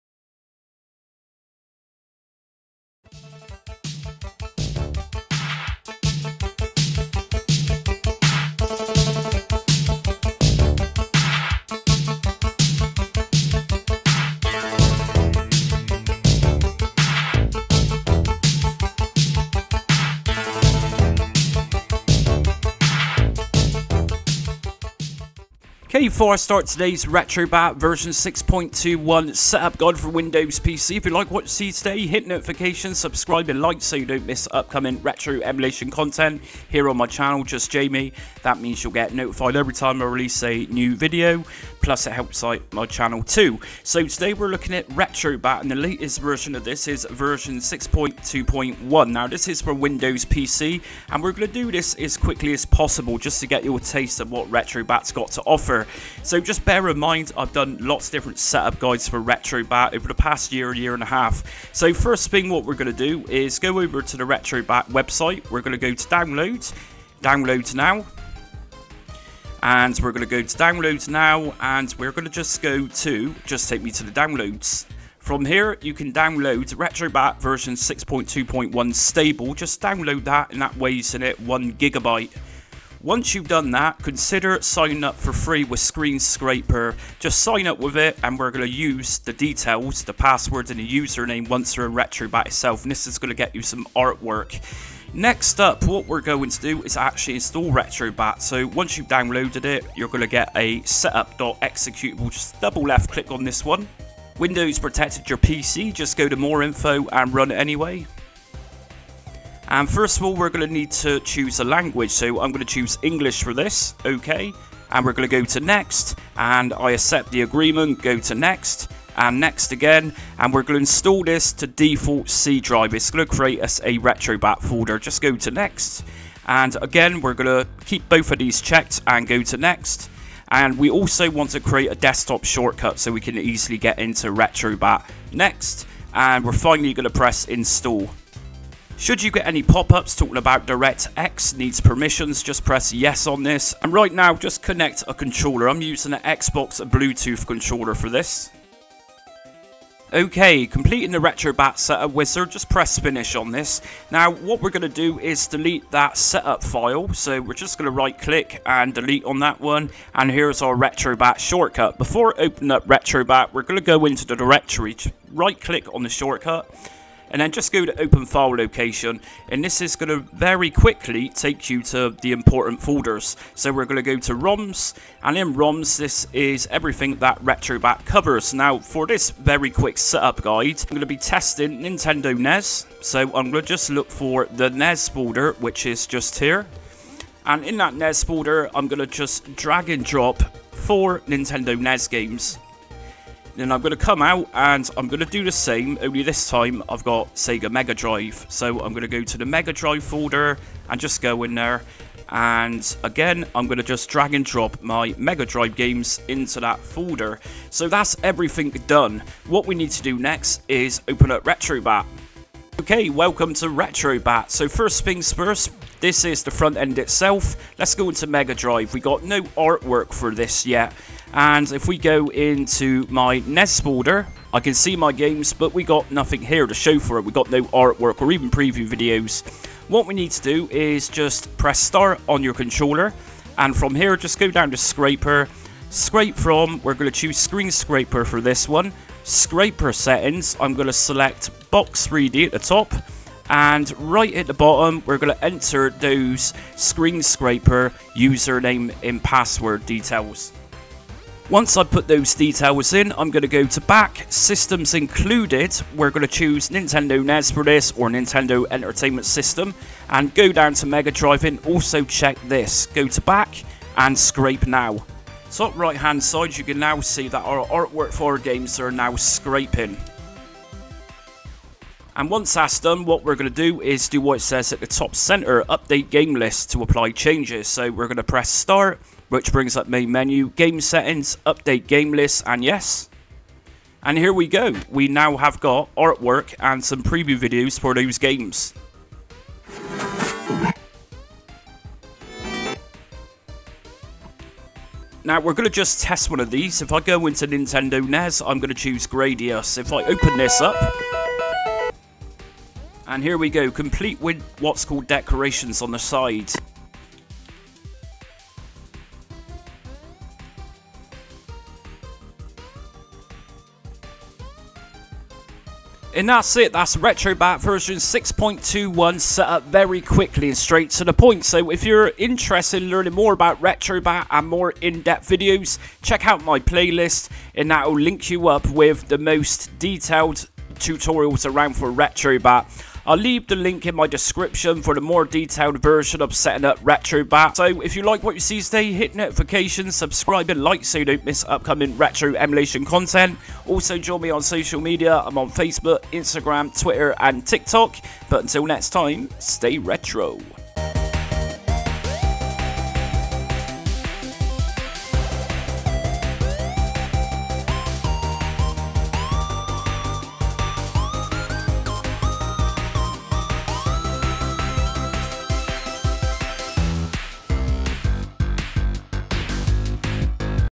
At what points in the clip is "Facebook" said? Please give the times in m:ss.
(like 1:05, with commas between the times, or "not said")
5:45.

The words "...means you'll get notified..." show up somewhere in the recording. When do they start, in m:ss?
0:38.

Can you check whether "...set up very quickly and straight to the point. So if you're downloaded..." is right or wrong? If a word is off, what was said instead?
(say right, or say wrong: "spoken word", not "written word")
wrong: "interested", not "downloaded".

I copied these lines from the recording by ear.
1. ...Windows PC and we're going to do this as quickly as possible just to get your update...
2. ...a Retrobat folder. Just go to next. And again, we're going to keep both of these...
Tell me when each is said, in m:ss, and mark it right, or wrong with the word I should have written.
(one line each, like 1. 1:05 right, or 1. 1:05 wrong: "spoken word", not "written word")
1. 0:49 wrong: "taste", not "update"
2. 2:03 right.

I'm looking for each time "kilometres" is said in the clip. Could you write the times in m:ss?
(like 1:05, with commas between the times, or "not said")
not said.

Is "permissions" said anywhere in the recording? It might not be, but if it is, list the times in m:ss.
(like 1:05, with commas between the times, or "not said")
2:21.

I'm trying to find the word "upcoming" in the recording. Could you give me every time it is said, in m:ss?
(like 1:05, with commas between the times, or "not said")
0:34, 5:41.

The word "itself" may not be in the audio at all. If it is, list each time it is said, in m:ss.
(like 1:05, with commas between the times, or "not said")
1:32, 3:36.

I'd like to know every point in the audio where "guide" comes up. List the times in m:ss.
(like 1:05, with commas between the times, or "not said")
0:29, 0:58, 3:00.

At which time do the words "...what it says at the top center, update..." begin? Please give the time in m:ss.
4:34.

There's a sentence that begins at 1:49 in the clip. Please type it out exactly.
And first of all, we're going to need to choose a language.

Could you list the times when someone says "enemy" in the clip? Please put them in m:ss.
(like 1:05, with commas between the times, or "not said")
not said.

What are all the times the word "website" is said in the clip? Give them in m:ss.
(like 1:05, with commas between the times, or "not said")
1:04.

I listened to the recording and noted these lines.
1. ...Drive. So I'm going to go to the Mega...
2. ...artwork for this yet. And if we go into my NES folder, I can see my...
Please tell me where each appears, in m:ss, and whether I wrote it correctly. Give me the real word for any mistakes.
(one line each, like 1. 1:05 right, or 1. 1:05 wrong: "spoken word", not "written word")
1. 3:17 right
2. 3:39 right.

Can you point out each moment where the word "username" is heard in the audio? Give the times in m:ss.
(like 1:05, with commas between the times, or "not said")
1:30, 4:08.